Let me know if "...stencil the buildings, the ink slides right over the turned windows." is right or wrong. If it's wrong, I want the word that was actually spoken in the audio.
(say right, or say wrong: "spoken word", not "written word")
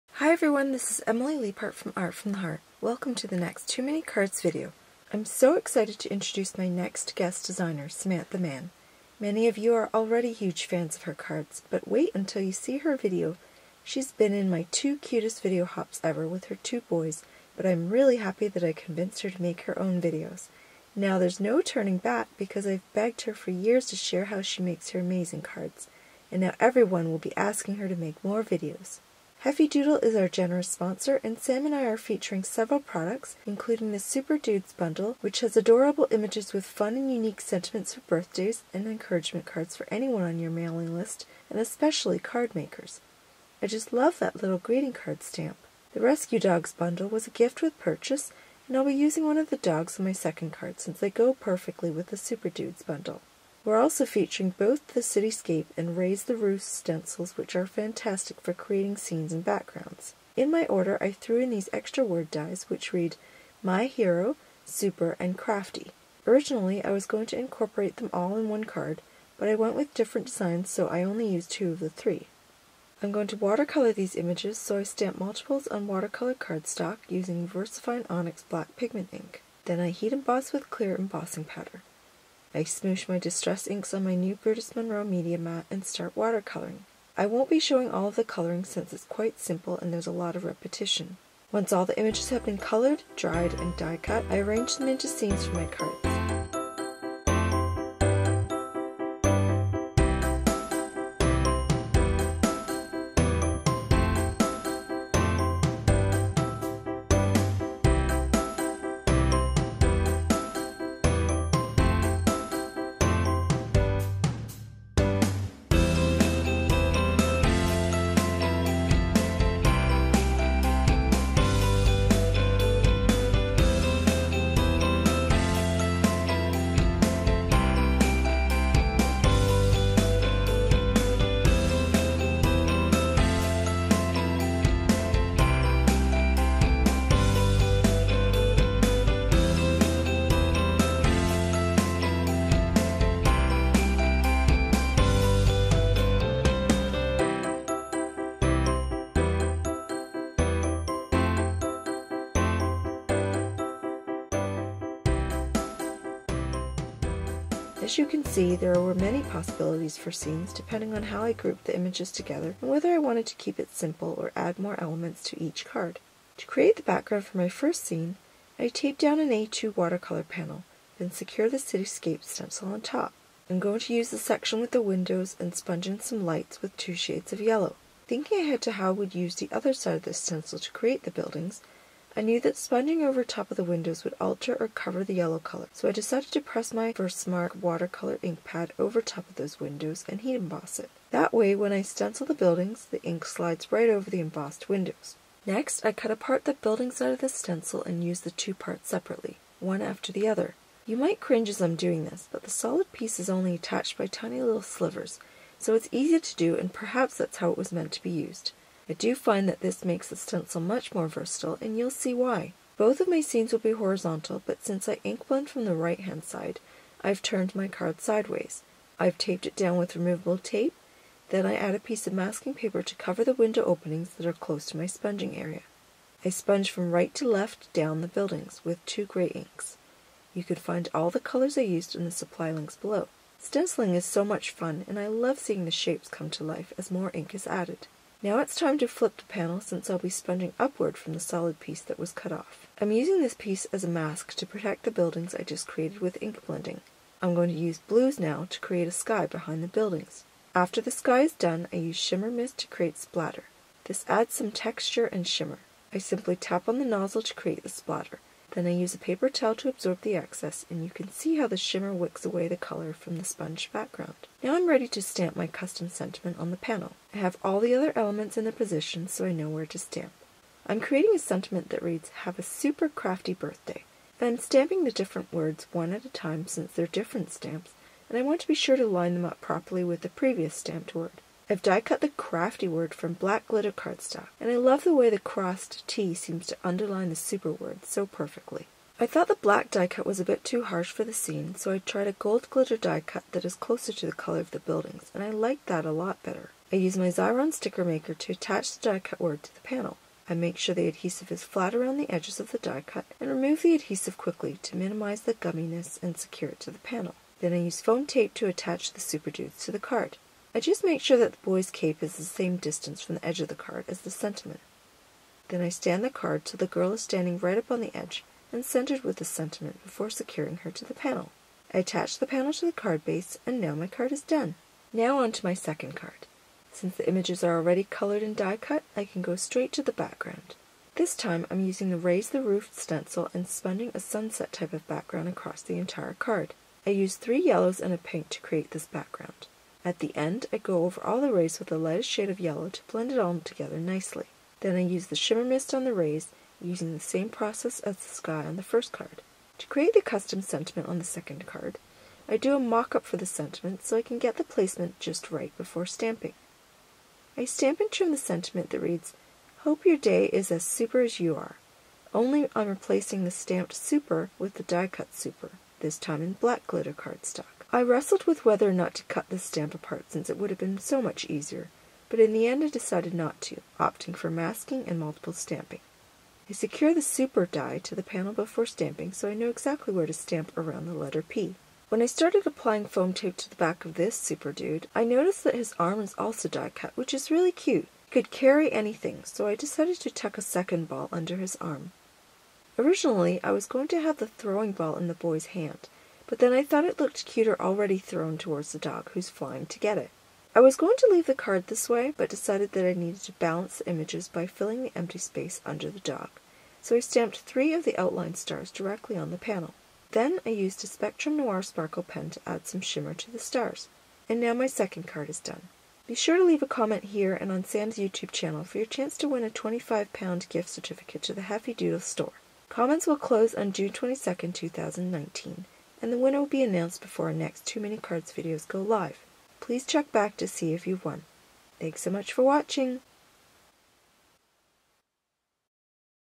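wrong: "embossed", not "turned".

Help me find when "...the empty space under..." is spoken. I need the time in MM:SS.
06:44.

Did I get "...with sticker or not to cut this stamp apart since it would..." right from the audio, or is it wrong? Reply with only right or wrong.
wrong.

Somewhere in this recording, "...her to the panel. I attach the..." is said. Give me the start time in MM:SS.
05:20.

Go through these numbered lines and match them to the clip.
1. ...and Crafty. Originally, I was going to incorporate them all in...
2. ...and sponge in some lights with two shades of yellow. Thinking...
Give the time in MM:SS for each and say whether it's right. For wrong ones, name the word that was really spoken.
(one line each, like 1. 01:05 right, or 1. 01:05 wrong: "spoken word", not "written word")
1. 01:05 right
2. 02:55 right.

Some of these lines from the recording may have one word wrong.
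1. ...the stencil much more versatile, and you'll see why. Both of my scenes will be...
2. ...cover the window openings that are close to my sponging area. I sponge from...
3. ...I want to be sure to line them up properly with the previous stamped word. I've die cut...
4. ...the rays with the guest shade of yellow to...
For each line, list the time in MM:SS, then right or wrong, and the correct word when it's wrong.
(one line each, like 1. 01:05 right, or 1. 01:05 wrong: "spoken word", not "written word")
1. 03:30 right
2. 03:42 right
3. 04:38 right
4. 05:41 wrong: "lightest", not "guest".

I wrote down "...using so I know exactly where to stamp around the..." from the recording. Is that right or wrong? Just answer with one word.
wrong.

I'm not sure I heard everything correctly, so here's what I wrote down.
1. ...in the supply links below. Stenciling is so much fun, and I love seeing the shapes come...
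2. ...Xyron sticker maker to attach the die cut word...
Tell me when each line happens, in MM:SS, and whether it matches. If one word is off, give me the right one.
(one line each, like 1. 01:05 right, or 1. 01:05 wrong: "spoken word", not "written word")
1. 03:51 right
2. 04:57 right.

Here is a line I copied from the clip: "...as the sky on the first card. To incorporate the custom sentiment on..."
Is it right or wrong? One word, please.
wrong.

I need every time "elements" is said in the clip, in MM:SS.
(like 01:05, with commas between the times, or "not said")
02:44, 04:27.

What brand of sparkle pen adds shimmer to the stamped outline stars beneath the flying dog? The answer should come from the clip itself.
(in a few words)
Spectrum Noir.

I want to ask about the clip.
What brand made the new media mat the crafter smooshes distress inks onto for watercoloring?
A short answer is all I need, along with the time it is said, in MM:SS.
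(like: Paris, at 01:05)
Brutus Monroe, at 01:24.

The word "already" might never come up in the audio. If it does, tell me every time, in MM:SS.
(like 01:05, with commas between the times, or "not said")
00:09, 05:27, 06:37.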